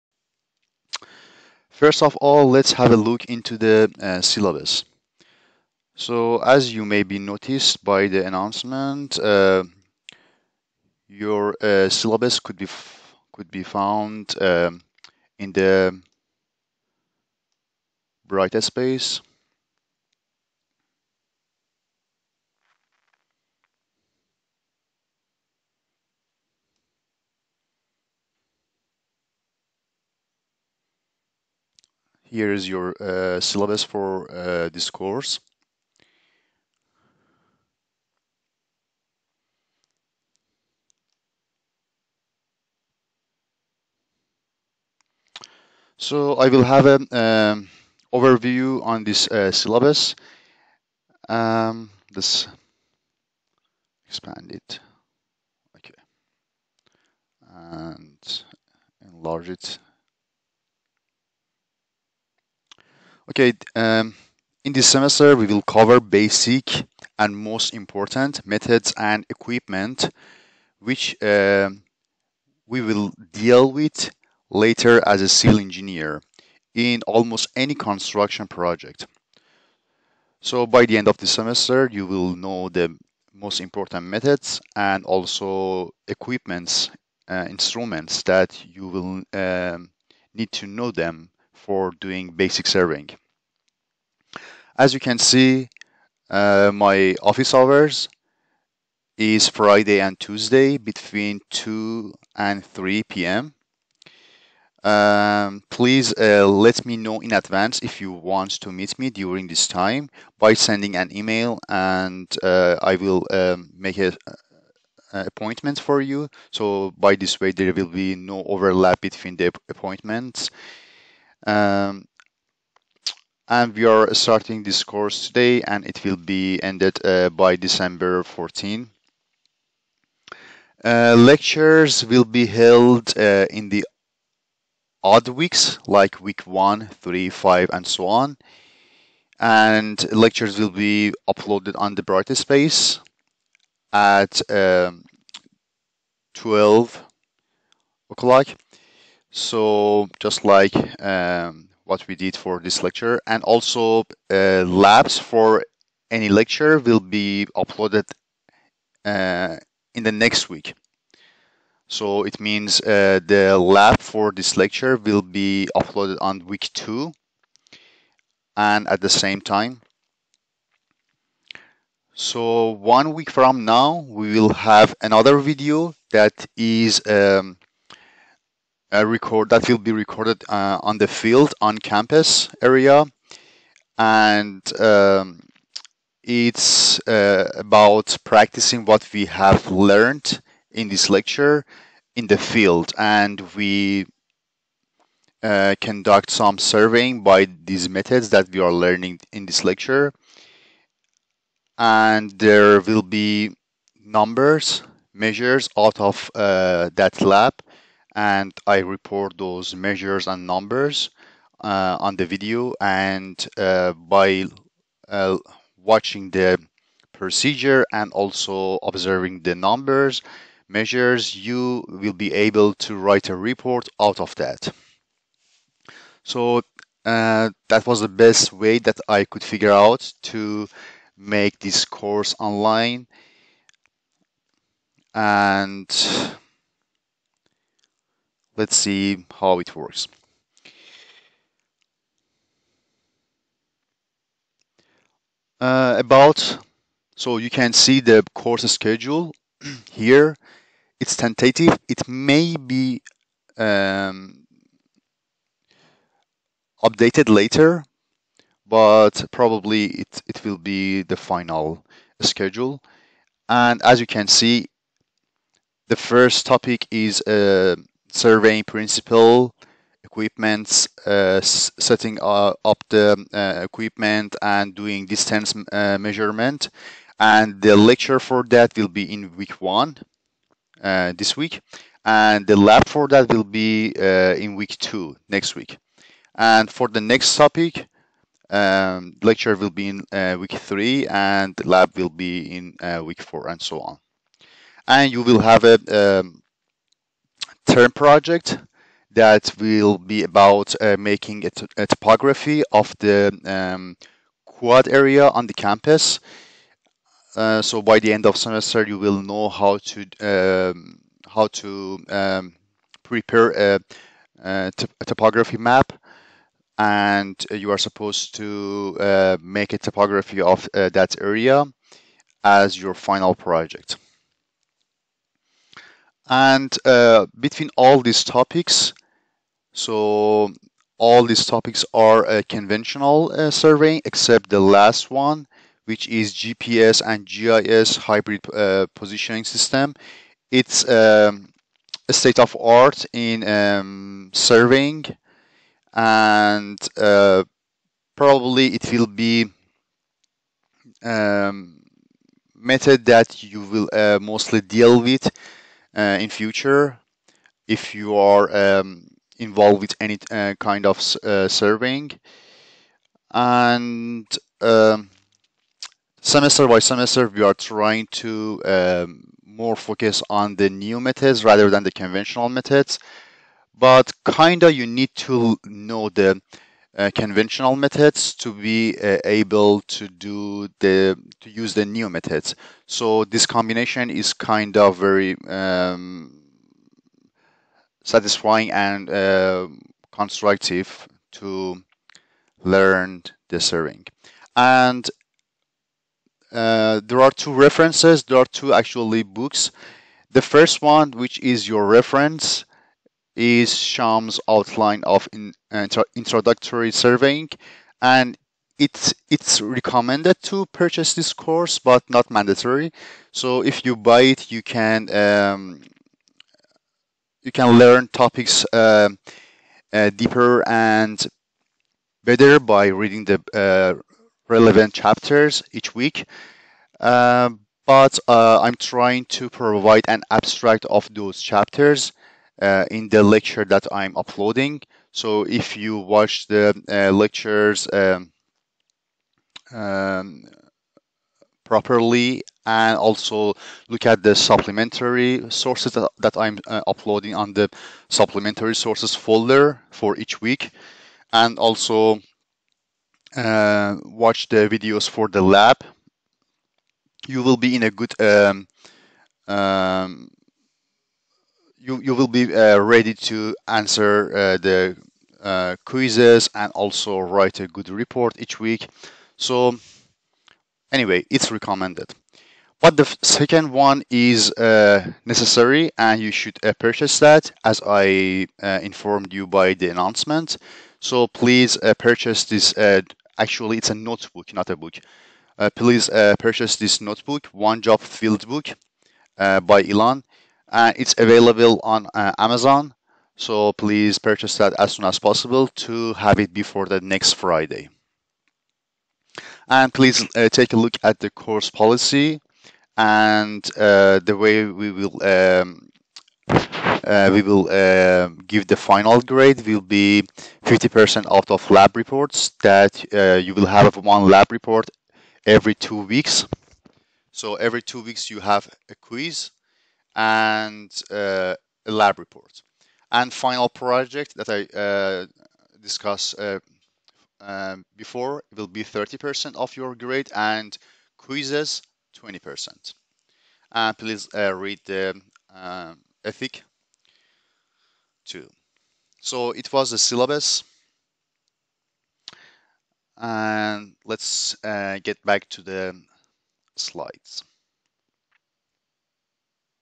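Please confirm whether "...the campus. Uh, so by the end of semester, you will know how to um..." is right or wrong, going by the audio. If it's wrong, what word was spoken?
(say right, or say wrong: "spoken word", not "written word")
right.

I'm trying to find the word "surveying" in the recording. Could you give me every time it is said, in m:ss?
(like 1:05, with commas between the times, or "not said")
1:32, 3:16, 4:28, 5:33, 5:44, 6:01, 6:33, 6:46.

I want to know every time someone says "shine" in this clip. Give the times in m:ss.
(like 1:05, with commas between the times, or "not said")
not said.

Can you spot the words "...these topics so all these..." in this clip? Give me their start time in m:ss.
5:28.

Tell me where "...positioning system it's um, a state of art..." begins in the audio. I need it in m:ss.
5:38.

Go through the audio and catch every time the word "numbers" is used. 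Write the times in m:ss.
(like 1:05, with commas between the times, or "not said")
3:24, 3:30, 3:39.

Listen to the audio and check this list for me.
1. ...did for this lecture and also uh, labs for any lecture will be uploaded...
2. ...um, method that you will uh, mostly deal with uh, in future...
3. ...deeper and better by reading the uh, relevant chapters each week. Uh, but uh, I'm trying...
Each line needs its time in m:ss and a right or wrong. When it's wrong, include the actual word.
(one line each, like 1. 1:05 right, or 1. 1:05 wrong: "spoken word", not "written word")
1. 2:32 right
2. 5:51 right
3. 7:00 right.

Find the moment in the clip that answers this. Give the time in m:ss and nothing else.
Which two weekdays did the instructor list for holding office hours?
1:39.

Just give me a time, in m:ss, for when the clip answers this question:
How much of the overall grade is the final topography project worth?
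8:48.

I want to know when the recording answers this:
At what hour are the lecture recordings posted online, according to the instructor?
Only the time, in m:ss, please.
2:26.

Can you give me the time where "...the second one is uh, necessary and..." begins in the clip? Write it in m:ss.
7:52.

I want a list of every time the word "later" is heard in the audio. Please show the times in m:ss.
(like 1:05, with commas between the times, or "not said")
1:14, 4:17.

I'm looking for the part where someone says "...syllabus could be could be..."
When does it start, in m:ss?
0:11.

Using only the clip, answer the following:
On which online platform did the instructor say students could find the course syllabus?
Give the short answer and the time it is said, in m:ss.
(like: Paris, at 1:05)
Brightspace, at 0:18.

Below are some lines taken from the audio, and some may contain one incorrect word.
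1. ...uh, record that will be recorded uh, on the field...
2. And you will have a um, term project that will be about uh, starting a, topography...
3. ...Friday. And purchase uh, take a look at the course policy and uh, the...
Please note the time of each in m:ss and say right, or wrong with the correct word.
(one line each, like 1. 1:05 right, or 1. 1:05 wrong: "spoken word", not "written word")
1. 2:58 right
2. 4:54 wrong: "making", not "starting"
3. 8:17 wrong: "please", not "purchase".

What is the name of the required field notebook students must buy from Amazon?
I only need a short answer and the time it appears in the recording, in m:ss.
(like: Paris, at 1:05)
One Job Field Book, at 8:07.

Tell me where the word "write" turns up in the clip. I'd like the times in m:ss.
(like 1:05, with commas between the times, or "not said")
3:42, 7:47.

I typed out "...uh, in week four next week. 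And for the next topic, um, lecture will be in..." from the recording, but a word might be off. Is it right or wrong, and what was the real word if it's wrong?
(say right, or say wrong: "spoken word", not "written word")
wrong: "two", not "four".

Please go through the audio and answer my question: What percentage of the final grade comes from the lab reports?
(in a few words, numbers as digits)
50%.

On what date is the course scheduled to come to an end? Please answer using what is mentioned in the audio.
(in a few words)
December 14.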